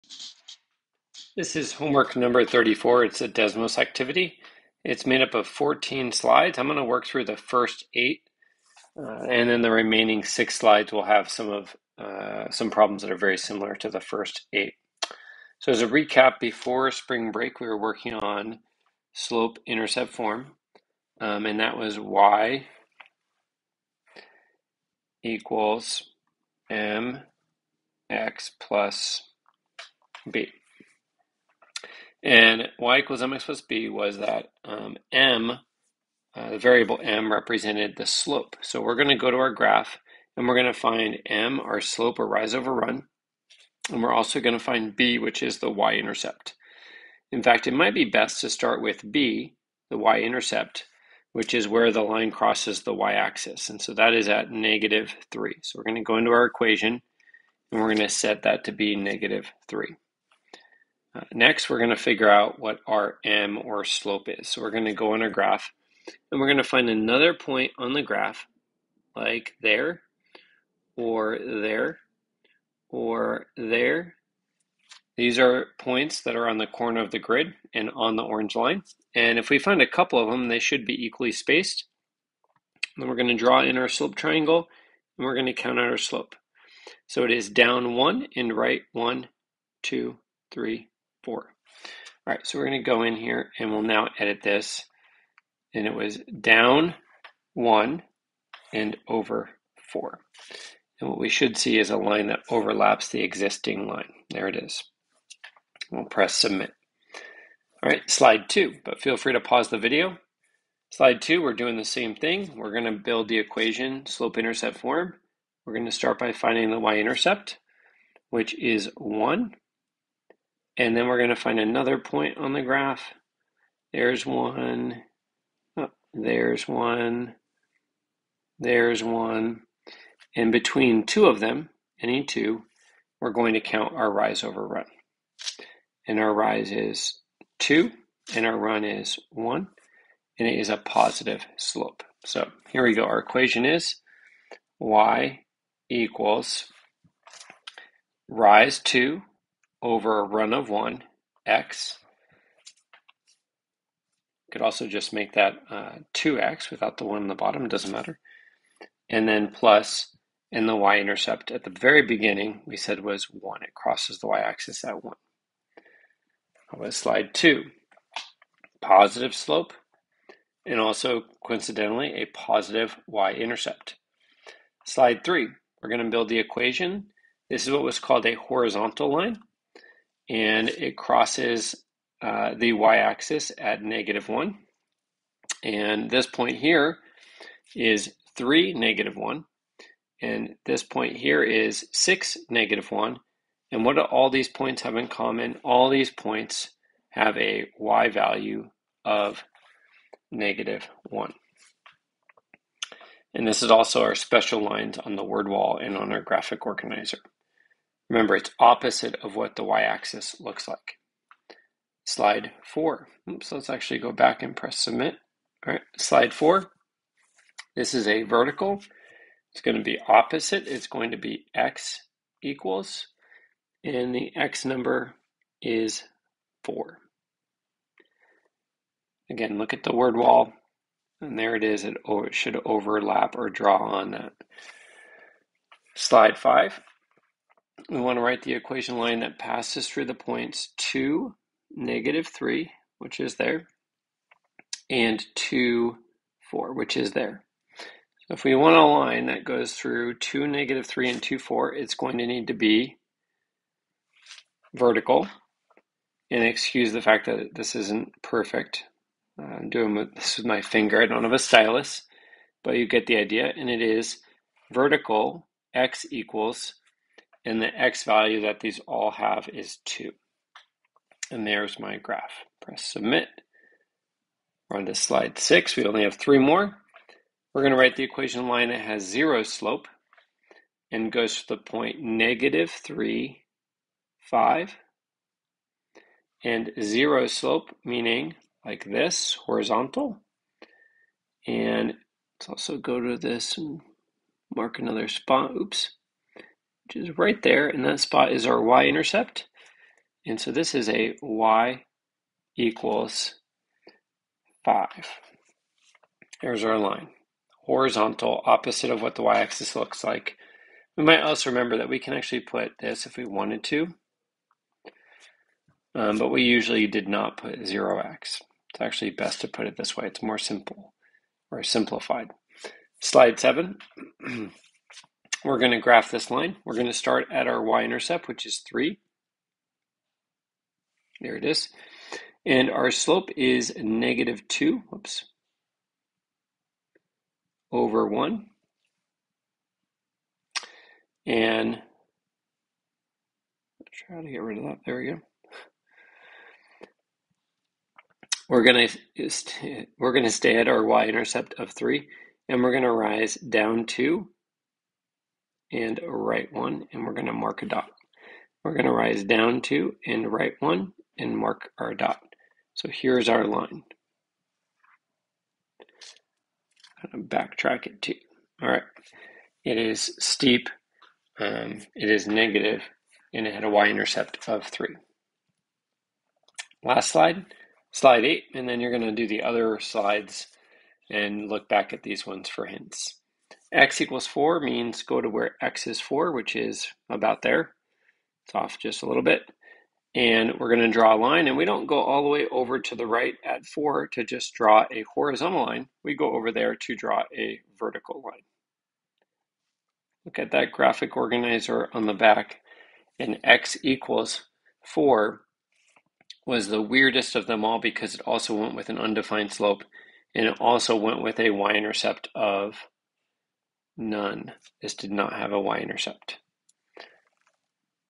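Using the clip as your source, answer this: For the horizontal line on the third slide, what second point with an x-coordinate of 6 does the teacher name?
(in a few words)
(6, -1).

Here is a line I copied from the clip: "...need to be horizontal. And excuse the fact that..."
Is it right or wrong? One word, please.
wrong.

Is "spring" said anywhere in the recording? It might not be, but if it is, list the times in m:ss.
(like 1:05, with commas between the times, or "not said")
0:16.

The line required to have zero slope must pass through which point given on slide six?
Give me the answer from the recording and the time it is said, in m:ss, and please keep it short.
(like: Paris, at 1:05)
(-3, 5), at 4:41.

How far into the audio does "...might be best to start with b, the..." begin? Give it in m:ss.
0:47.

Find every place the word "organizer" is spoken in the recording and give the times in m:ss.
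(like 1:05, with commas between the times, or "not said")
3:26, 6:41.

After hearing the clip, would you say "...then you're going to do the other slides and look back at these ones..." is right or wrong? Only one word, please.
right.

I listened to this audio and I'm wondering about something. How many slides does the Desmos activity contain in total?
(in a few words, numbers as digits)
14.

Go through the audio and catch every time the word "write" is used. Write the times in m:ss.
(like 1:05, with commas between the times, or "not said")
3:58, 4:37.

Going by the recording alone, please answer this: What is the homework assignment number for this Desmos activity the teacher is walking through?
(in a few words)
34.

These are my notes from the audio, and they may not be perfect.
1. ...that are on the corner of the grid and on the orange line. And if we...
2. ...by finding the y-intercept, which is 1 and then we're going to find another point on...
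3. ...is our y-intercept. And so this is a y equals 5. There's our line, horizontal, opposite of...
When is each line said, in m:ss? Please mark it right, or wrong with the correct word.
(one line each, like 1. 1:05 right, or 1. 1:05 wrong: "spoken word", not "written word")
1. 1:16 right
2. 1:56 right
3. 4:58 right.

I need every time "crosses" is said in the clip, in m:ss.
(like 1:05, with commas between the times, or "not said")
0:52, 2:43, 3:00.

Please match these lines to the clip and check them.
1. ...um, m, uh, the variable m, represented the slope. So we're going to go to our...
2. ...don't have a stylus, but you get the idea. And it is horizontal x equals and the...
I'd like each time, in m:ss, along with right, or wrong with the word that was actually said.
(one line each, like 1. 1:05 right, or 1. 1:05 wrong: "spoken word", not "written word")
1. 0:34 right
2. 4:21 wrong: "vertical", not "horizontal".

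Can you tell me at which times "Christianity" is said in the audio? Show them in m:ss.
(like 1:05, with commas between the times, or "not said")
not said.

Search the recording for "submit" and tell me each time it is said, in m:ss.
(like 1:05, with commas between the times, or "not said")
1:46, 3:34, 4:32.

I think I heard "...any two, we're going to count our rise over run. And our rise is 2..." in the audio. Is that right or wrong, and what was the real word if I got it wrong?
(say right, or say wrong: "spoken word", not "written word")
right.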